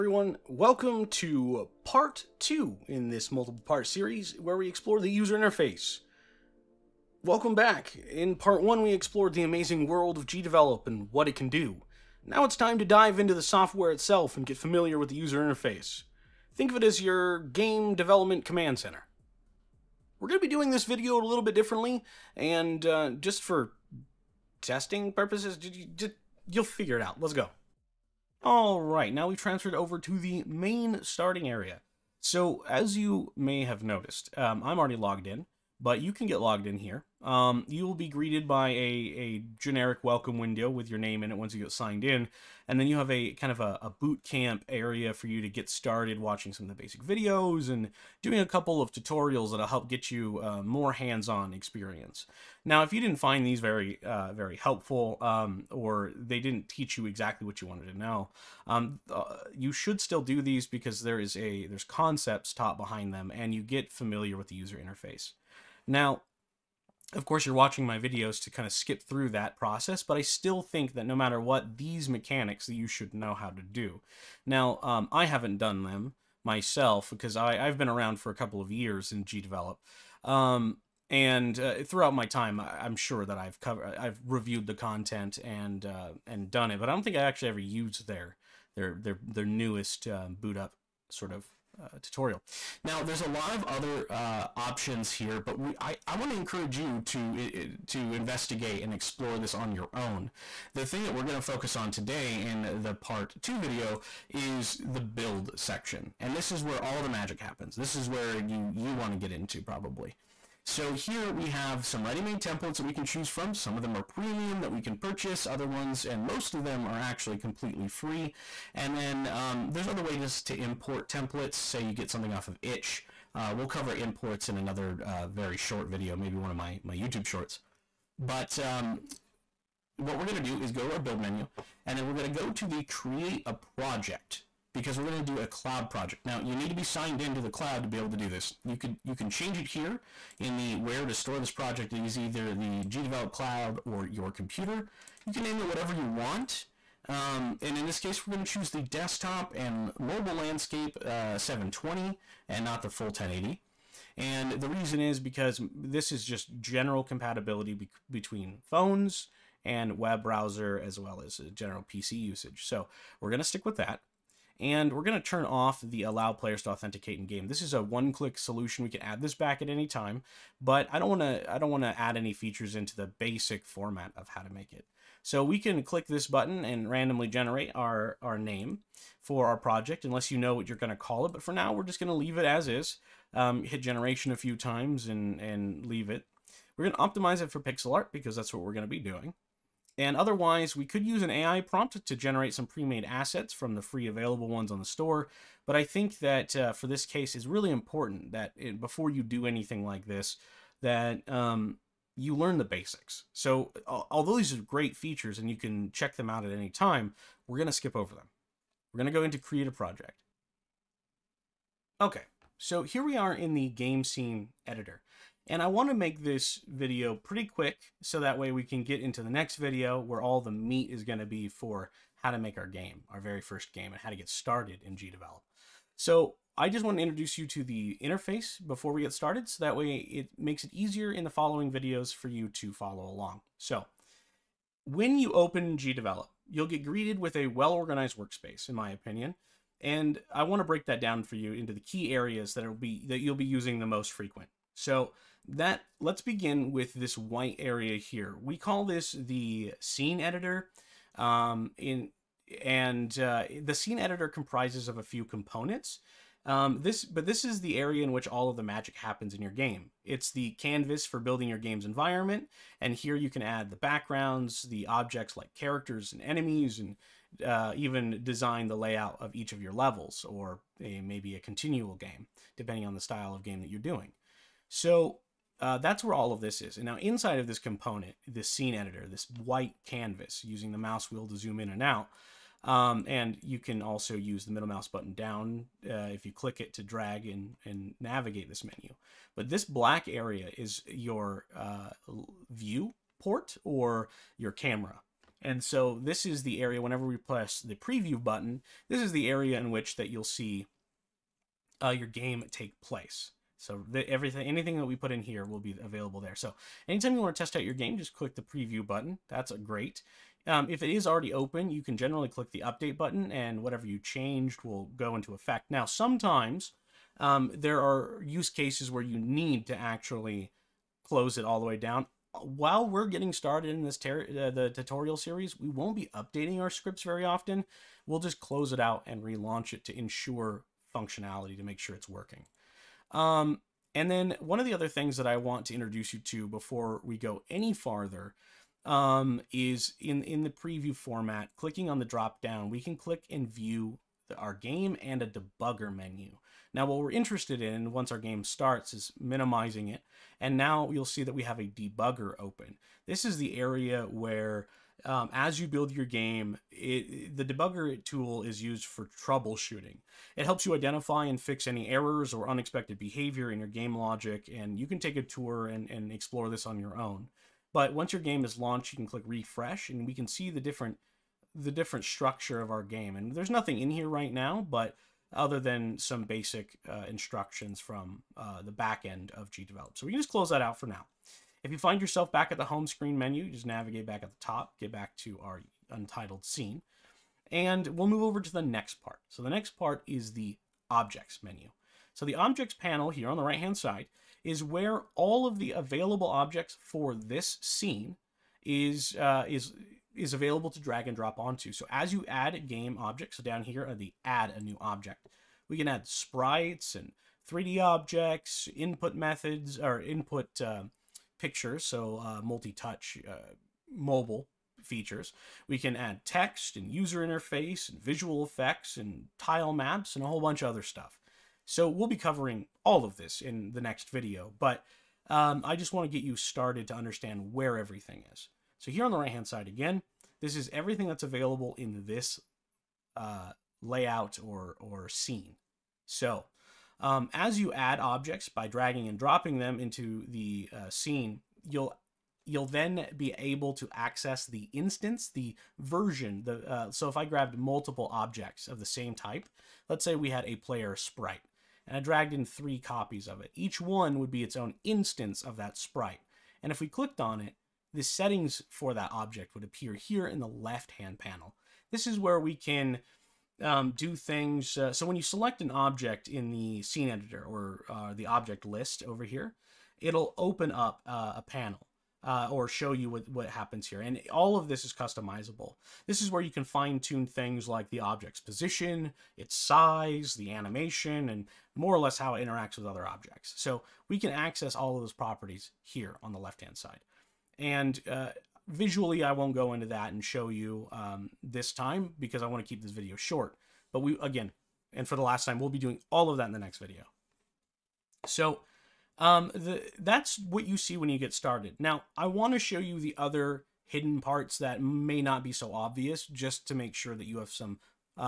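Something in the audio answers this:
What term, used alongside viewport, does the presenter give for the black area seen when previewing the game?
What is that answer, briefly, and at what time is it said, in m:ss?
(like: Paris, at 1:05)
Camera, at 4:54.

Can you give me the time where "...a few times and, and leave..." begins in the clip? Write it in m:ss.
3:04.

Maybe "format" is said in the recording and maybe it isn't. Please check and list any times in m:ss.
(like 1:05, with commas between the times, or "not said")
2:53, 5:40.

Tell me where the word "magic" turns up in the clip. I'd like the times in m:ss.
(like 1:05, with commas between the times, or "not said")
1:47, 4:18.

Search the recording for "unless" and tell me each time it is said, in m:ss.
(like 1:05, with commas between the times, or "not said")
3:00.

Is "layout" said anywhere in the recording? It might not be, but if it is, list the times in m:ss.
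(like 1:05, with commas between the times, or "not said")
4:28, 7:13.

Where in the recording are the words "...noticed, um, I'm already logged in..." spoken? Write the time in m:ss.
0:33.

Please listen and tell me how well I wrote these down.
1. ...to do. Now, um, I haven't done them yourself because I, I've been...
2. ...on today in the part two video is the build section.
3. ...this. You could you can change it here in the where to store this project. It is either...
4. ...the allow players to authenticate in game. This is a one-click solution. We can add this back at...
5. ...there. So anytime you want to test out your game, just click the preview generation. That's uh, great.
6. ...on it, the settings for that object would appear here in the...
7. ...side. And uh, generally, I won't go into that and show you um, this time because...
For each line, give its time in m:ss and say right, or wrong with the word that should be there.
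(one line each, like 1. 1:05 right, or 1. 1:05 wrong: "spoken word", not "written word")
1. 1:13 wrong: "myself", not "yourself"
2. 1:41 right
3. 2:18 right
4. 2:45 right
5. 5:06 wrong: "button", not "generation"
6. 7:37 right
7. 8:06 wrong: "visually", not "generally".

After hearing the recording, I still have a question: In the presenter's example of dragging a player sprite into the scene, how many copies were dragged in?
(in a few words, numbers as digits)
3.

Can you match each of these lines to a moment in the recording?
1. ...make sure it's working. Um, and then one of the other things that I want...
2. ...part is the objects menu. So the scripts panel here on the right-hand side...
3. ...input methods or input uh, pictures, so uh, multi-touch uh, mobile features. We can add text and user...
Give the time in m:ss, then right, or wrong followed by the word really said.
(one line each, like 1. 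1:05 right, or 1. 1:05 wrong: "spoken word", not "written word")
1. 5:31 right
2. 6:29 wrong: "objects", not "scripts"
3. 6:48 right.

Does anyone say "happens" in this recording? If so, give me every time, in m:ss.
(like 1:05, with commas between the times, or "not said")
1:47, 4:18, 7:53.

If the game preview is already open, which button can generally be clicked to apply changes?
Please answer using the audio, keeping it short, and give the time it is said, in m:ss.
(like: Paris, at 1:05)
Update button, at 5:12.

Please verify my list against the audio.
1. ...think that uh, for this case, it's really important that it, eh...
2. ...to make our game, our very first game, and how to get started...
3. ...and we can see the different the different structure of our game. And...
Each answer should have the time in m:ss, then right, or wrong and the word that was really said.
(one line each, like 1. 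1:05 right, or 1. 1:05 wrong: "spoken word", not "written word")
1. 3:15 right
2. 3:42 right
3. 6:09 right.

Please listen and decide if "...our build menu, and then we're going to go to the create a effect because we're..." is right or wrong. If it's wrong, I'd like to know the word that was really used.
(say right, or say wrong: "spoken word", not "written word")
wrong: "project", not "effect".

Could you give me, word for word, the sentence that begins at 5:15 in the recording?
Now, sometimes um, there are use cases where you need to actually close it all the way down.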